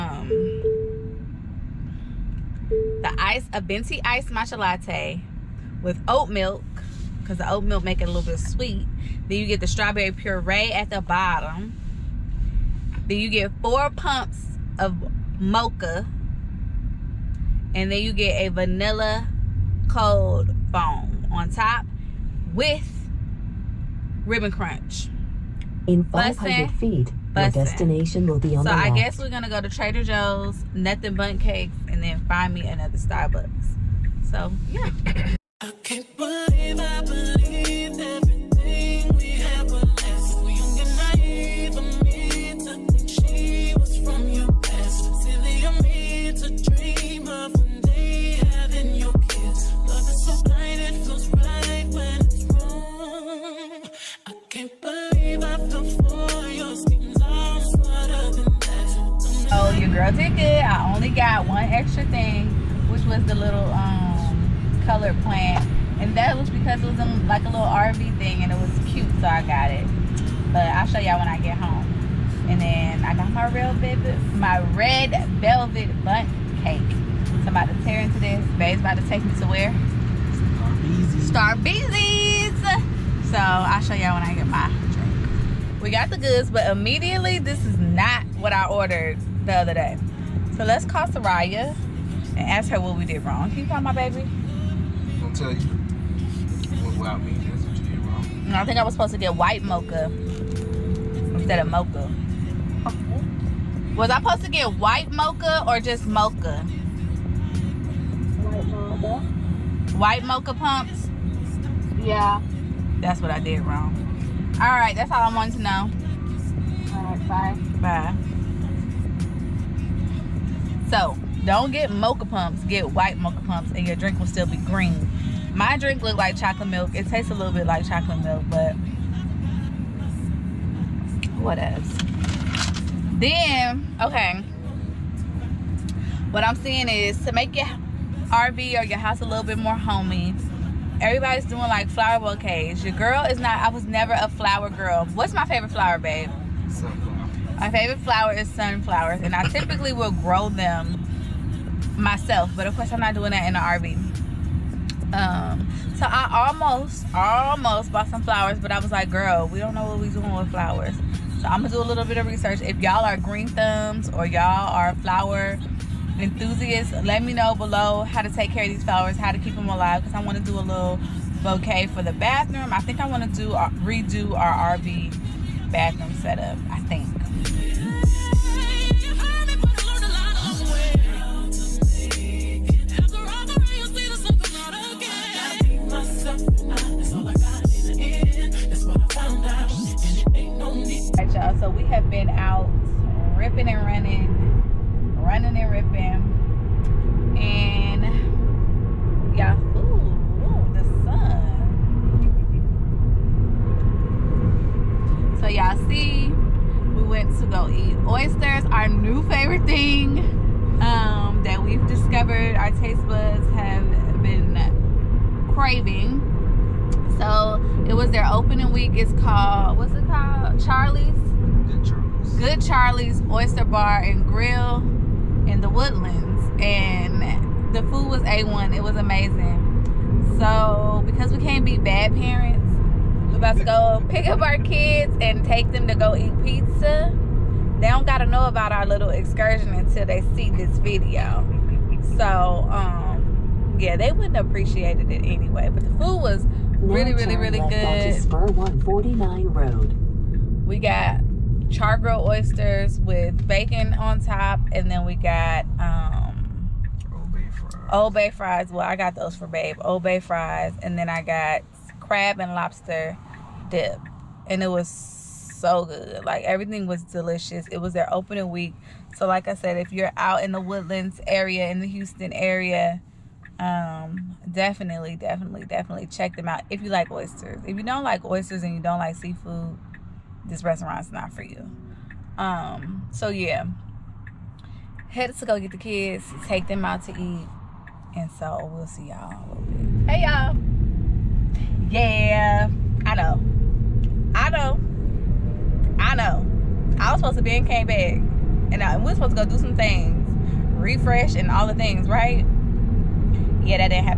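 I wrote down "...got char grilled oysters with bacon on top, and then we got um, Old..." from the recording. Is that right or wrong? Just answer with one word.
right.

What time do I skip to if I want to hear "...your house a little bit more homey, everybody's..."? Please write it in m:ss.
2:18.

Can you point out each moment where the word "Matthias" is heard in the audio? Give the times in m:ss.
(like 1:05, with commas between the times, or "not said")
not said.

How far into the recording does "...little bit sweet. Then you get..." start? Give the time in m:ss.
0:08.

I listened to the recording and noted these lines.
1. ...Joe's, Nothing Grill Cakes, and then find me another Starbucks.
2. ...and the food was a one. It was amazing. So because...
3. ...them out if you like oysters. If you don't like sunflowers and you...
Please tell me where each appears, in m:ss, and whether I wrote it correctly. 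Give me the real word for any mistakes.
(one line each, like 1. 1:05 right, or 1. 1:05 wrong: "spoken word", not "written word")
1. 0:30 wrong: "Bundt", not "Grill"
2. 3:46 right
3. 4:36 wrong: "oysters", not "sunflowers".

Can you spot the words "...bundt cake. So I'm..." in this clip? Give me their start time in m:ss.
1:16.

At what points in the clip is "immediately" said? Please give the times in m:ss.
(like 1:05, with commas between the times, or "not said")
1:26.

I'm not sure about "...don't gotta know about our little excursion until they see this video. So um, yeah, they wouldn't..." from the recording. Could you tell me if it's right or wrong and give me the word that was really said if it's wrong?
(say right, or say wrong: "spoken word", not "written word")
right.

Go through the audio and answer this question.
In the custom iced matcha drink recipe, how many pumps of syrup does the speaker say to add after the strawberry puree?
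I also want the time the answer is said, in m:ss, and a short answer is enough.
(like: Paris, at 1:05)
4, at 0:13.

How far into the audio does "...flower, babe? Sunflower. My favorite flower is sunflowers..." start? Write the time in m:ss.
2:25.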